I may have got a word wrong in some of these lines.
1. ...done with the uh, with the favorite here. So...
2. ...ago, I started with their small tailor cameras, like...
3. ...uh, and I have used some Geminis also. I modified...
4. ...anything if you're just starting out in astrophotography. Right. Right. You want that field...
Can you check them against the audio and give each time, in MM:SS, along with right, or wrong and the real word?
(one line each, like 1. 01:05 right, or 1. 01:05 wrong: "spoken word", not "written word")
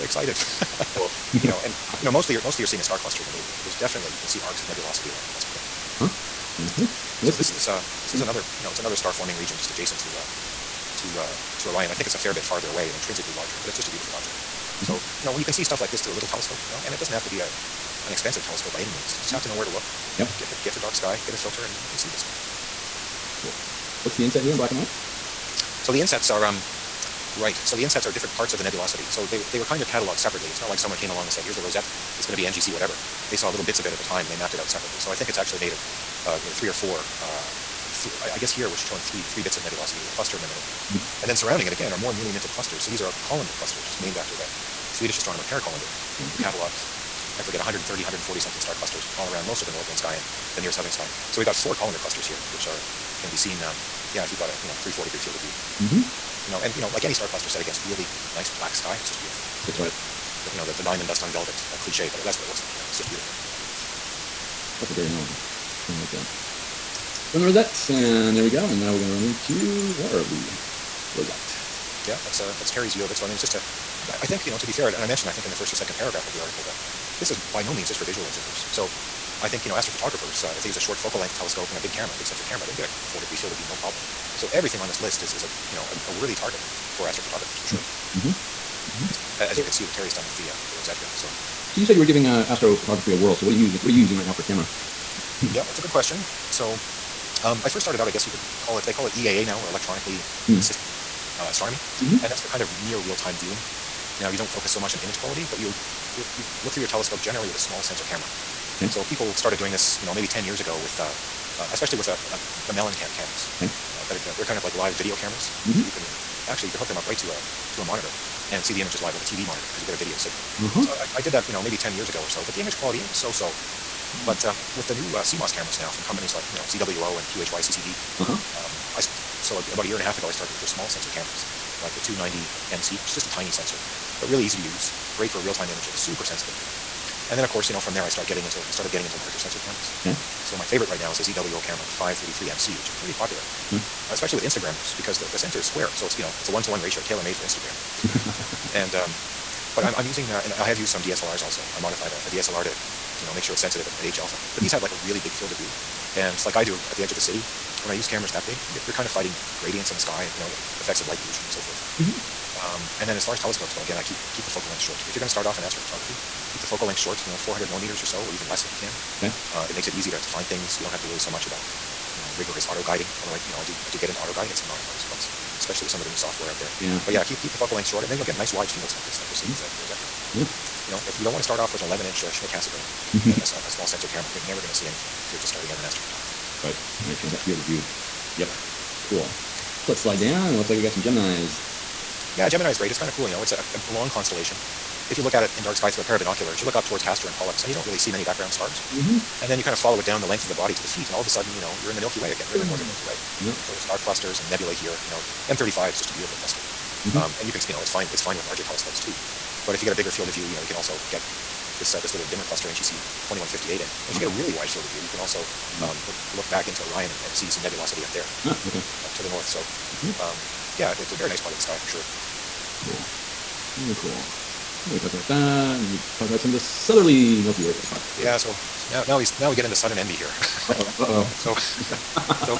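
1. 01:30 wrong: "rosette", not "favorite"
2. 02:10 wrong: "sensor", not "tailor"
3. 02:30 wrong: "DSLRs", not "Geminis"
4. 03:04 right.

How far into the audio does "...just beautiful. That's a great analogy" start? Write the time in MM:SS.
01:02.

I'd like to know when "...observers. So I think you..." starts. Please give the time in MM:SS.
01:18.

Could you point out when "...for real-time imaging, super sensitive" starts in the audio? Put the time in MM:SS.
02:15.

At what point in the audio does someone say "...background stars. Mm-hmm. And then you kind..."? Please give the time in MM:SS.
03:18.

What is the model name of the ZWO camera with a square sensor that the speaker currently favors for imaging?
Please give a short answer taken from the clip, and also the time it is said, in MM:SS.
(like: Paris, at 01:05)
533 MC, at 02:21.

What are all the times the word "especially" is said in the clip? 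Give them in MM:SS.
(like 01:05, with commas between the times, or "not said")
01:51, 02:24, 02:55.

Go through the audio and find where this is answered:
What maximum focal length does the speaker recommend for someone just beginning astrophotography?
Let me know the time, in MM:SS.
02:47.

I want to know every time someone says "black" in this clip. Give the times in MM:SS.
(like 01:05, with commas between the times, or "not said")
00:24, 00:58.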